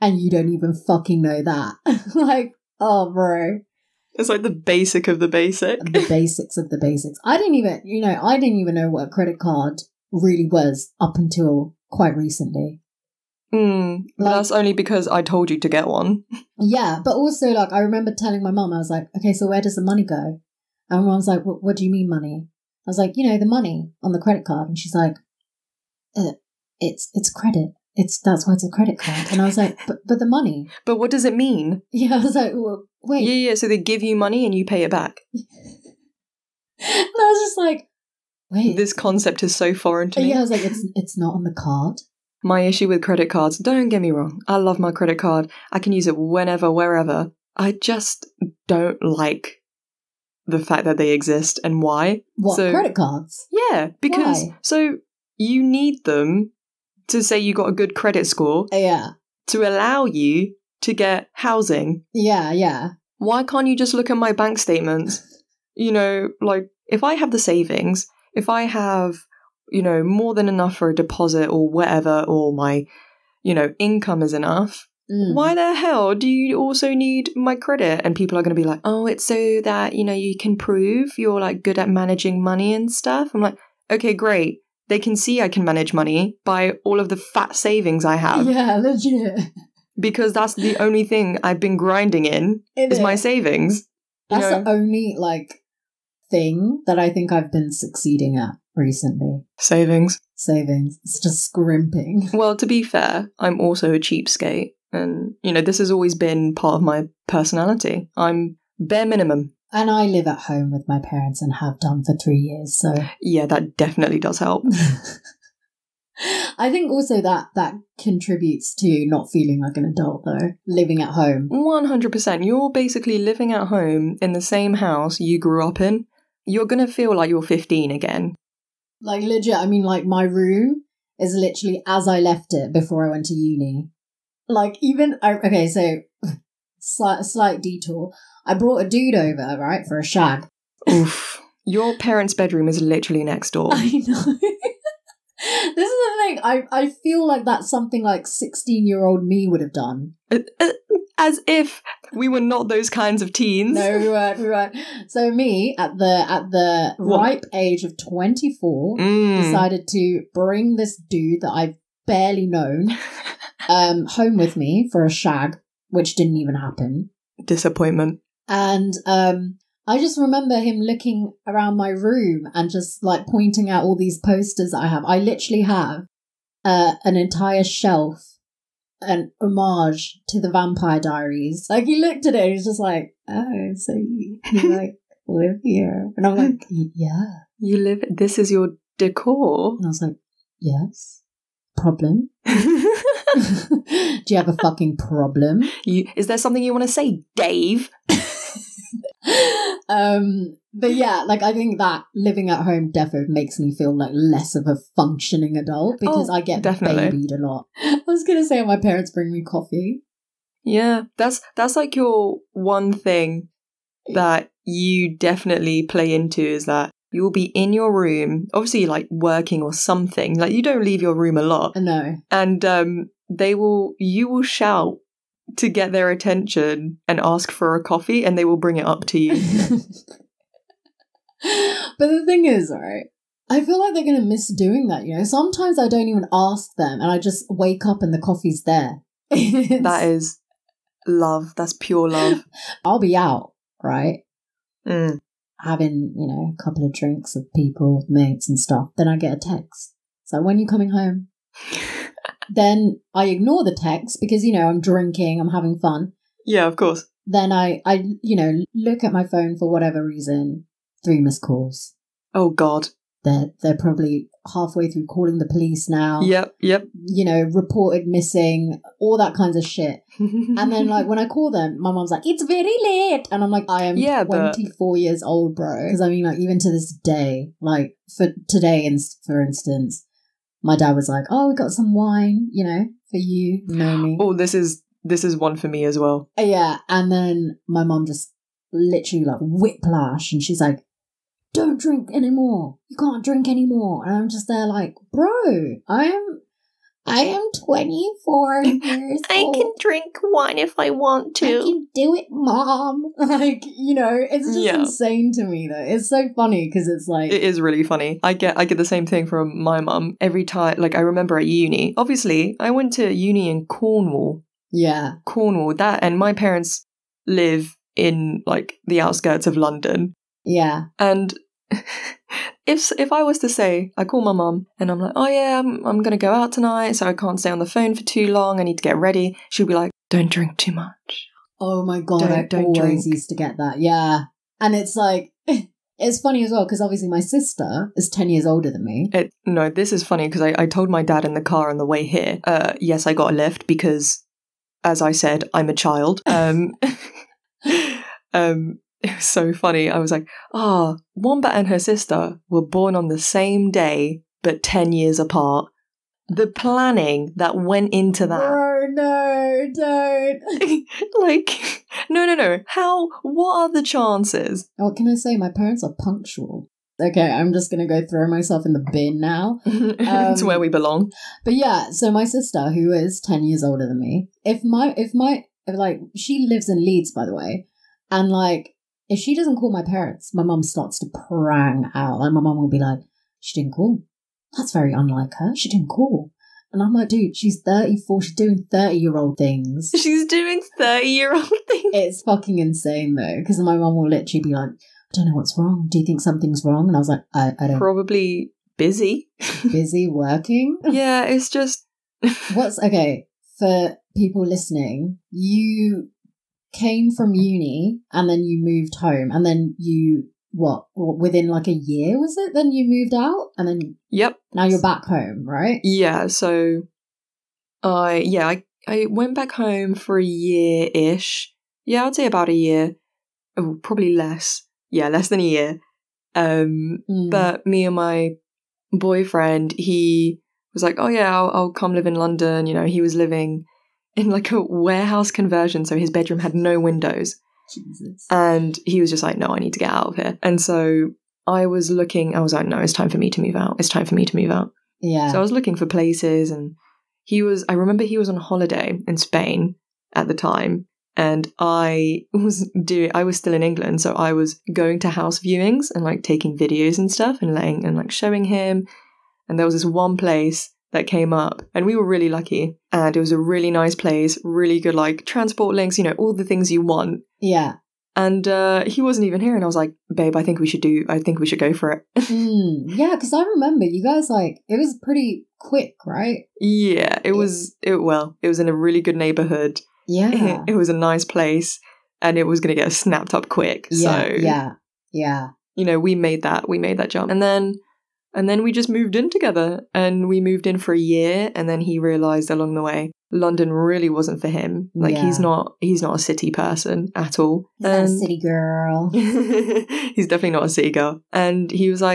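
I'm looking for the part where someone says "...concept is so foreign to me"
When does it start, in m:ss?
0:38.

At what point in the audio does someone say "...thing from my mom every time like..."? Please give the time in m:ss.
5:09.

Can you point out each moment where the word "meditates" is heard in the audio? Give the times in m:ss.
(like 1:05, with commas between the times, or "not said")
not said.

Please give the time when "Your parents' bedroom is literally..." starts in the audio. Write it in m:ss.
2:21.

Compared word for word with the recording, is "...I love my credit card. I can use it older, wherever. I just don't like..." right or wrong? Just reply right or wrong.
wrong.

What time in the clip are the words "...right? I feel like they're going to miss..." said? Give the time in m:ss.
3:52.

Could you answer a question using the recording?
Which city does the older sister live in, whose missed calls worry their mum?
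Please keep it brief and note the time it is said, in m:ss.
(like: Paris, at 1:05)
Leeds, at 6:16.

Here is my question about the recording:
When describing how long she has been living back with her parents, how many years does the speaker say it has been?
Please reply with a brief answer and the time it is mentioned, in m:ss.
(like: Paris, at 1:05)
3 years, at 1:52.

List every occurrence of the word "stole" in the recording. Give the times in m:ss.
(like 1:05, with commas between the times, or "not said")
not said.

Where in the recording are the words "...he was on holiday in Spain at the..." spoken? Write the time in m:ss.
7:28.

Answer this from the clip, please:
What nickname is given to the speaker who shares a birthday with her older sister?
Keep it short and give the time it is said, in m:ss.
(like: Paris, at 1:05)
Wombat, at 5:51.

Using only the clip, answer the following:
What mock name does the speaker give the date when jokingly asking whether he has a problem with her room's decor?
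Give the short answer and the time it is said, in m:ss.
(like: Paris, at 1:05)
Dave, at 3:17.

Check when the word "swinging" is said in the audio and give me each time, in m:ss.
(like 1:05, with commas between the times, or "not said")
not said.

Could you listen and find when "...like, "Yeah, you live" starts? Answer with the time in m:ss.
3:06.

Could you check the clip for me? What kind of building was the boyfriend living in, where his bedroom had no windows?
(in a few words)
A warehouse conversion.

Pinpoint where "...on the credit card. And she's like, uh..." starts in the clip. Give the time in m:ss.
0:24.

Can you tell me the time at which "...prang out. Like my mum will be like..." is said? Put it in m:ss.
6:21.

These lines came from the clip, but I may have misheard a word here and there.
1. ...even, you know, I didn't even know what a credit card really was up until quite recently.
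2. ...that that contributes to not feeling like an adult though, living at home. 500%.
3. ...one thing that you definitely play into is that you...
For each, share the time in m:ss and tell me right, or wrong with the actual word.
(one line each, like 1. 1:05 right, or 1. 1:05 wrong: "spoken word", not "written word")
1. 0:07 right
2. 1:57 wrong: "100", not "500"
3. 3:32 right.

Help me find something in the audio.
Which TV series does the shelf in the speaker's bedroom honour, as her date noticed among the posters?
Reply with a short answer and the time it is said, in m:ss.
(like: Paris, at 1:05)
The Vampire Diaries, at 3:00.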